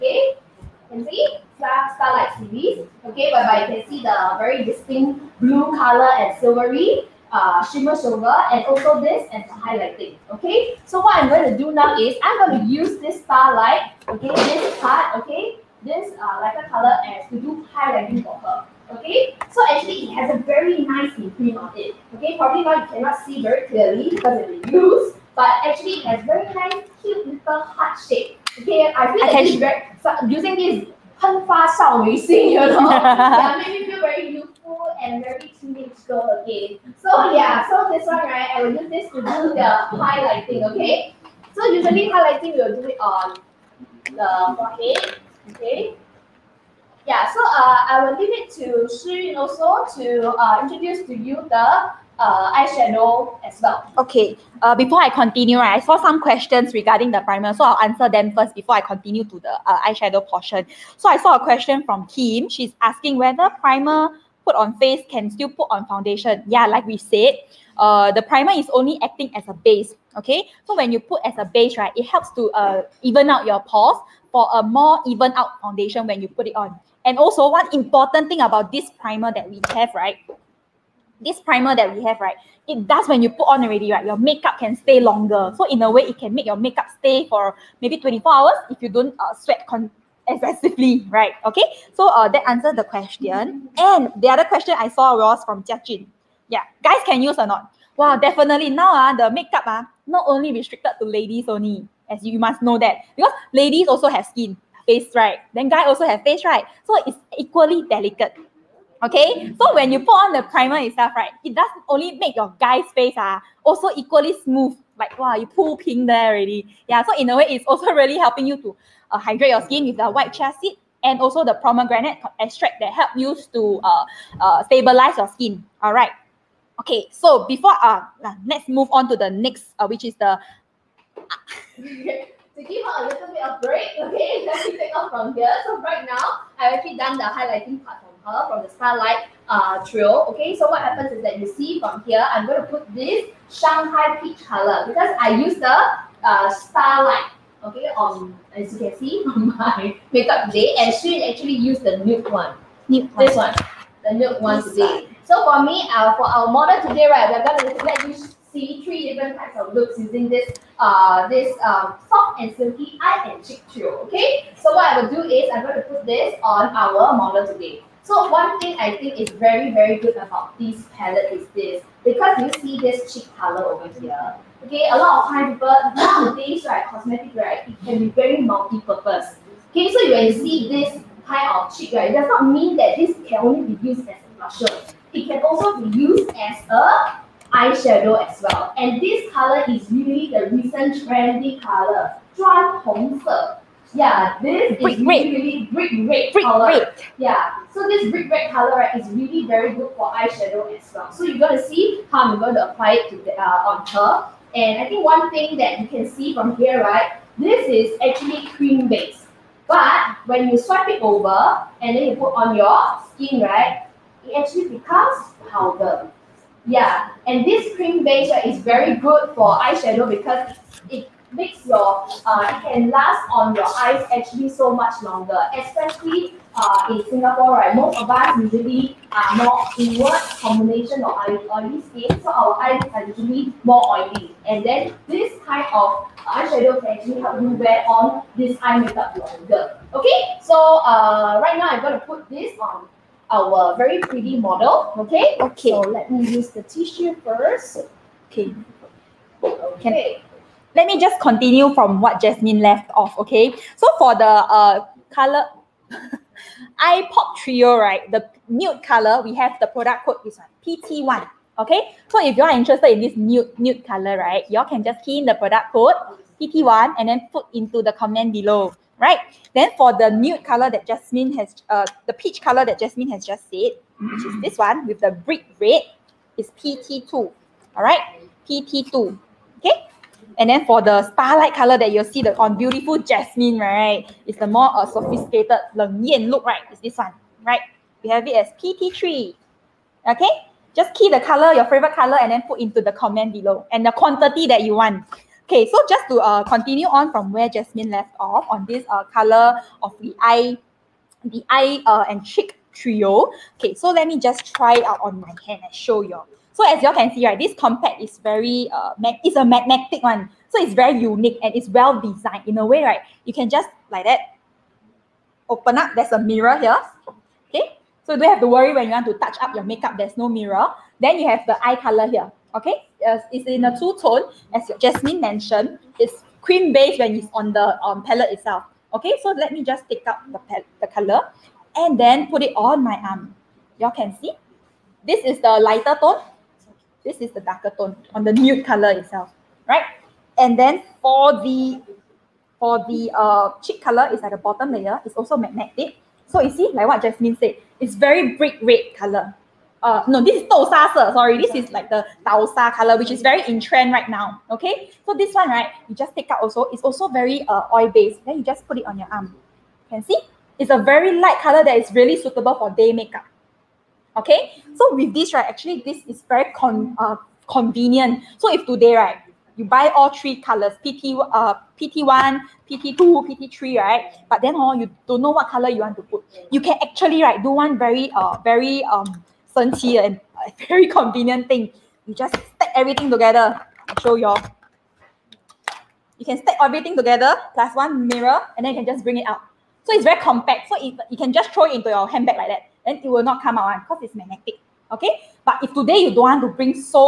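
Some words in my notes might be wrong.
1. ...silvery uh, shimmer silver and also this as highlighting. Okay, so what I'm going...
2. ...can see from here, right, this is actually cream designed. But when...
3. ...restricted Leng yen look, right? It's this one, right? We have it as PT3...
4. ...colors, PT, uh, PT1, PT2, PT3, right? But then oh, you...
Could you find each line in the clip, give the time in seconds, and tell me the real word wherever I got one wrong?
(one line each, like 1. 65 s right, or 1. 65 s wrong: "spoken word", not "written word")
1. 6 s right
2. 205 s wrong: "based", not "designed"
3. 284 s wrong: "sophisticated", not "restricted"
4. 370 s right.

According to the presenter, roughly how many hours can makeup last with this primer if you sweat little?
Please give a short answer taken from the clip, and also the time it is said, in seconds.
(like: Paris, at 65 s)
24, at 87 s.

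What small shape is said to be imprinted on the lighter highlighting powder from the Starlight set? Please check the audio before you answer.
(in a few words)
Heart.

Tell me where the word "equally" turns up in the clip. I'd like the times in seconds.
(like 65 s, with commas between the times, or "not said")
107 s, 113 s.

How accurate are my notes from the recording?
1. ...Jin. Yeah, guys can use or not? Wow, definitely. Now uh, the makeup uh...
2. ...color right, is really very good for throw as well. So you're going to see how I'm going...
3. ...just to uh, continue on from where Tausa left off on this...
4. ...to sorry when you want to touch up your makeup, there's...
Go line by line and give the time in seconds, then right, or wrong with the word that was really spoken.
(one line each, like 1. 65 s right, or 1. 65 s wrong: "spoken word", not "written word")
1. 95 s right
2. 198 s wrong: "eyeshadow", not "throw"
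3. 295 s wrong: "Jasmine", not "Tausa"
4. 318 s wrong: "worry", not "sorry".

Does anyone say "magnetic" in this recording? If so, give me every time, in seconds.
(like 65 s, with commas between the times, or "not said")
309 s, 345 s, 394 s.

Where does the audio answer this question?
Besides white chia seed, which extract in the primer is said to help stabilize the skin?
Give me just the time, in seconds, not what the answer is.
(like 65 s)
121 s.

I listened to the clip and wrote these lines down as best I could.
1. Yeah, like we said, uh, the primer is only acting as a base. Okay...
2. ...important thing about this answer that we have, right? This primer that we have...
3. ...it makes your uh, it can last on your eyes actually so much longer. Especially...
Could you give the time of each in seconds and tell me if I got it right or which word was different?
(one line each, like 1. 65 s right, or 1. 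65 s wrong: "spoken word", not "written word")
1. 66 s right
2. 77 s wrong: "primer", not "answer"
3. 220 s right.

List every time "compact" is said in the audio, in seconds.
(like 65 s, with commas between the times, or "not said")
307 s, 390 s.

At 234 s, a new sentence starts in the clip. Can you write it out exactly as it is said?
And then this kind of eyeshadow can actually help you wear on this eye makeup longer.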